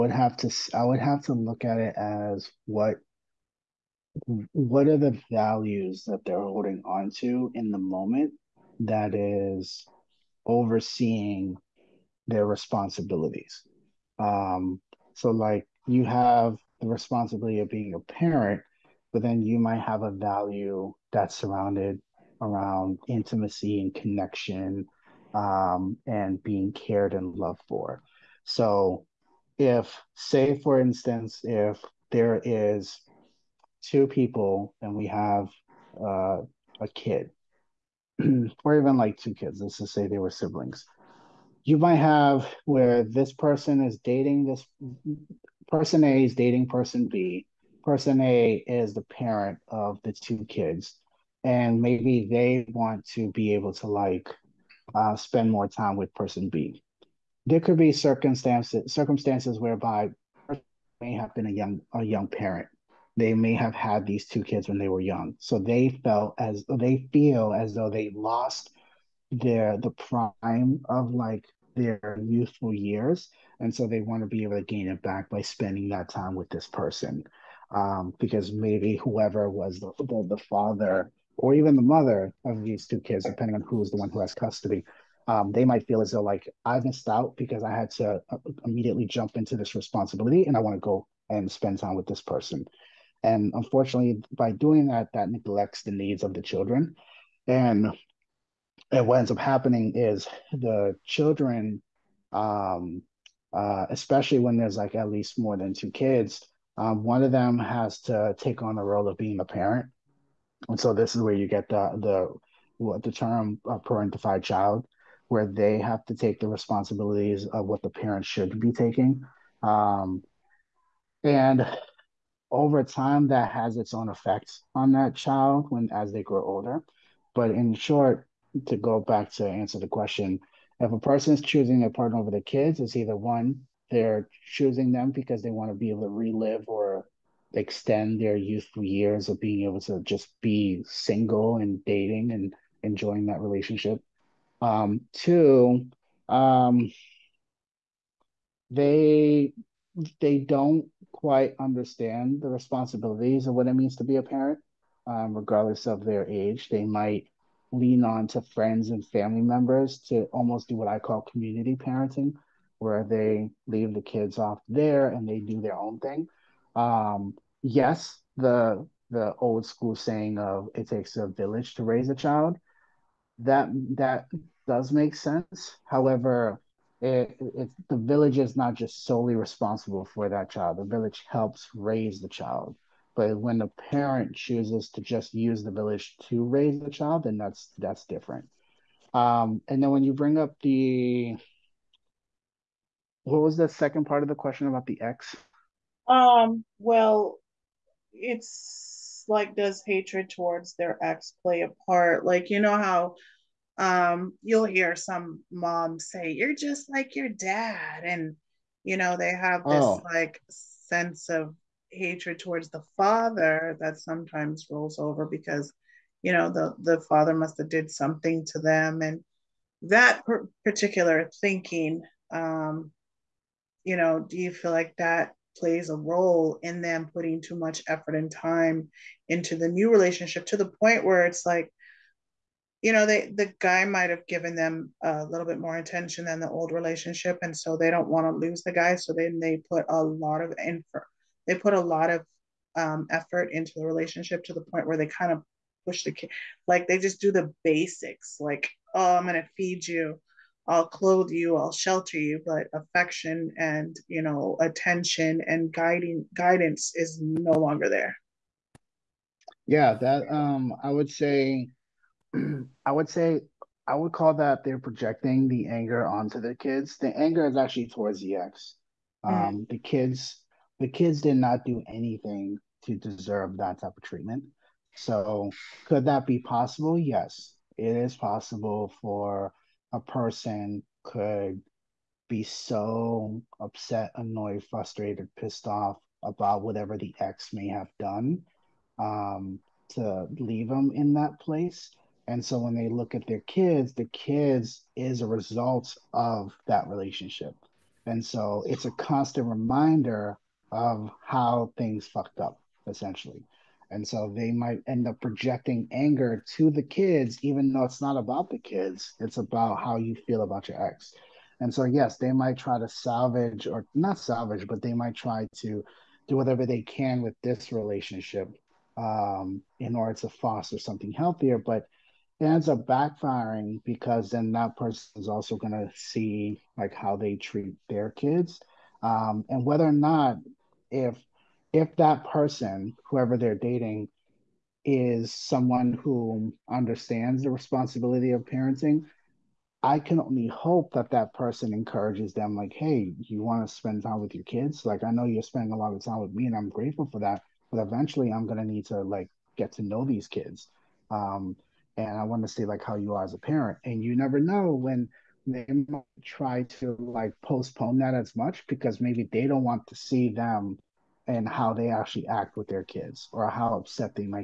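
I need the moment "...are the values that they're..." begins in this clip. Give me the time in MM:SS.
00:04.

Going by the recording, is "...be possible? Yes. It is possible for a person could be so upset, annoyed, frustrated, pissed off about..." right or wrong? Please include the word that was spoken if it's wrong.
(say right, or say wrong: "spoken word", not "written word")
right.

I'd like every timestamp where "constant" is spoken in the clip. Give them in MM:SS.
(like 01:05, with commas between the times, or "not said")
04:58.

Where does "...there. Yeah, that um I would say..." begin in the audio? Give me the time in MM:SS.
04:17.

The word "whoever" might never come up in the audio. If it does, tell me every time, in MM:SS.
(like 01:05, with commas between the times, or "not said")
01:18, 05:33.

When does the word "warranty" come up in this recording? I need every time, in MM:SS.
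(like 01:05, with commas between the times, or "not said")
not said.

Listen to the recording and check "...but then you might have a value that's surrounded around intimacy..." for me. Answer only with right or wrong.
right.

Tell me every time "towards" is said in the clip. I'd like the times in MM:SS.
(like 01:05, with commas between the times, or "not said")
03:20, 03:32, 04:27.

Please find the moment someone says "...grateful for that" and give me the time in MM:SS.
05:46.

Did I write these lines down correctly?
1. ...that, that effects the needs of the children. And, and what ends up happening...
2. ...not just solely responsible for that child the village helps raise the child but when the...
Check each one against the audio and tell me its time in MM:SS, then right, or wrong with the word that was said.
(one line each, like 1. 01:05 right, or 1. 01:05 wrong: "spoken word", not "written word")
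1. 01:34 wrong: "neglects", not "effects"
2. 02:58 right.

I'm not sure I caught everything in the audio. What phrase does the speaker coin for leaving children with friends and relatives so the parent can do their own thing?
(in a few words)
community parenting.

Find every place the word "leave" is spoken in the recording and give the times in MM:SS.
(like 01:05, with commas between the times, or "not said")
02:43, 04:50.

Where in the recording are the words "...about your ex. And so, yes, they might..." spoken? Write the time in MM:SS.
05:10.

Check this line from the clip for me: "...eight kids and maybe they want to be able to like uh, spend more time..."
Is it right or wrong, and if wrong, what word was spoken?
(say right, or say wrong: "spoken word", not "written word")
wrong: "two", not "eight".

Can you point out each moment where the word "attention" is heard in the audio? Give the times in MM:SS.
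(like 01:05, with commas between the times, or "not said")
03:55, 04:14.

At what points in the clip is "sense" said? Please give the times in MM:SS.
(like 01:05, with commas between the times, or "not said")
02:55, 03:30.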